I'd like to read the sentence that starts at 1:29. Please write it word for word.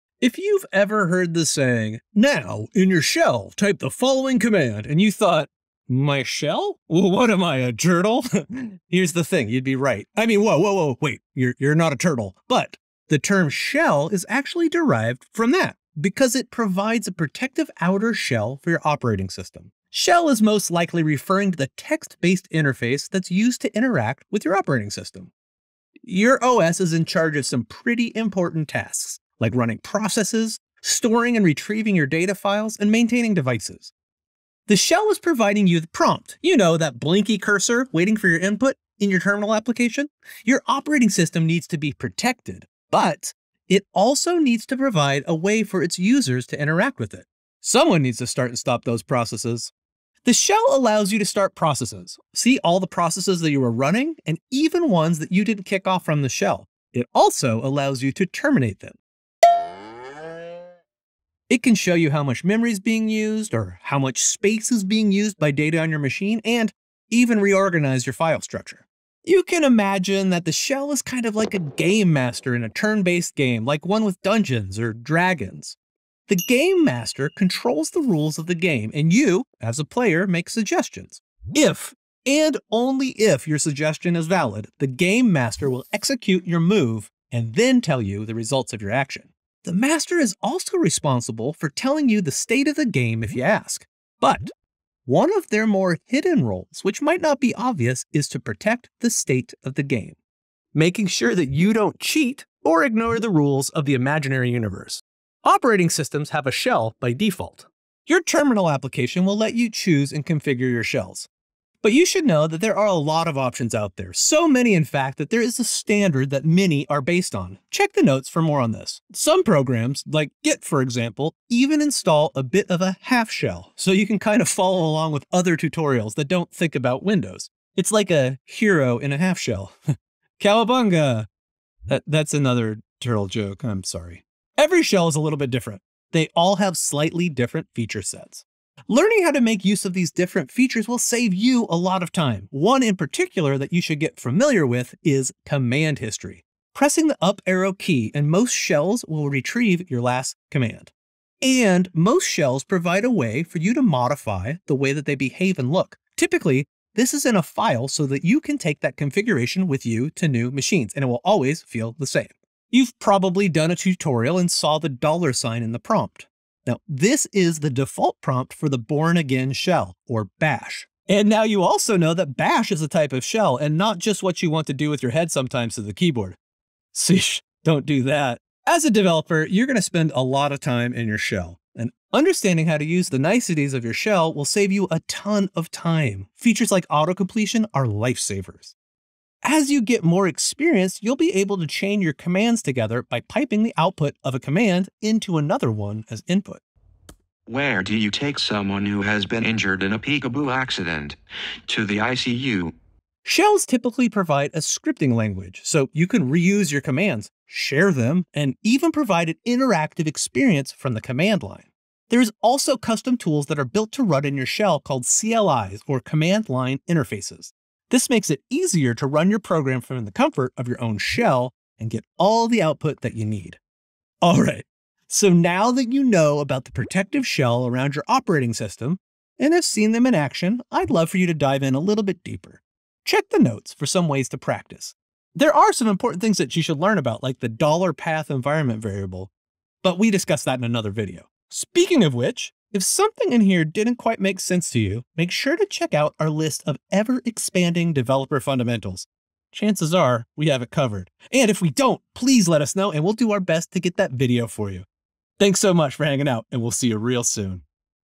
The master is also responsible for telling you the state of the game if you ask.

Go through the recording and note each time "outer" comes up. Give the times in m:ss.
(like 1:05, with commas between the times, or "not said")
0:17.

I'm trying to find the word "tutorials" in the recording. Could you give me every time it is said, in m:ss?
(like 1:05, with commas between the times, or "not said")
2:05, 2:43.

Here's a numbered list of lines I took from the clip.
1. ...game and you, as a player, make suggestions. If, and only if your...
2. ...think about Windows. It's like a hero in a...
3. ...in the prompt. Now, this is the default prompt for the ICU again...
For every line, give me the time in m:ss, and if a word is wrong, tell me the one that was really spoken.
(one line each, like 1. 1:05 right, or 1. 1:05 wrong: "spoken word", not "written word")
1. 1:18 right
2. 2:06 right
3. 2:45 wrong: "Bourne", not "ICU".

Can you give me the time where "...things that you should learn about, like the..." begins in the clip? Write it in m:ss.
3:56.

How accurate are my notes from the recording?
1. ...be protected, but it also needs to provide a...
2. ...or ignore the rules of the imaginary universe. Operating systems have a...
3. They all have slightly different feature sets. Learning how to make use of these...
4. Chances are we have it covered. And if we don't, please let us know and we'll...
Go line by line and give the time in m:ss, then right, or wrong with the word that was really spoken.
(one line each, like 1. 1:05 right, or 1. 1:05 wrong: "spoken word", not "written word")
1. 0:41 right
2. 1:42 right
3. 2:16 right
4. 4:09 right.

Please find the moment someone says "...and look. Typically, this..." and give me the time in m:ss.
2:35.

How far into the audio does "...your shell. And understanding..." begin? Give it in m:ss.
3:01.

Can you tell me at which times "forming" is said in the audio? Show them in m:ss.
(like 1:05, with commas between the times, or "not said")
not said.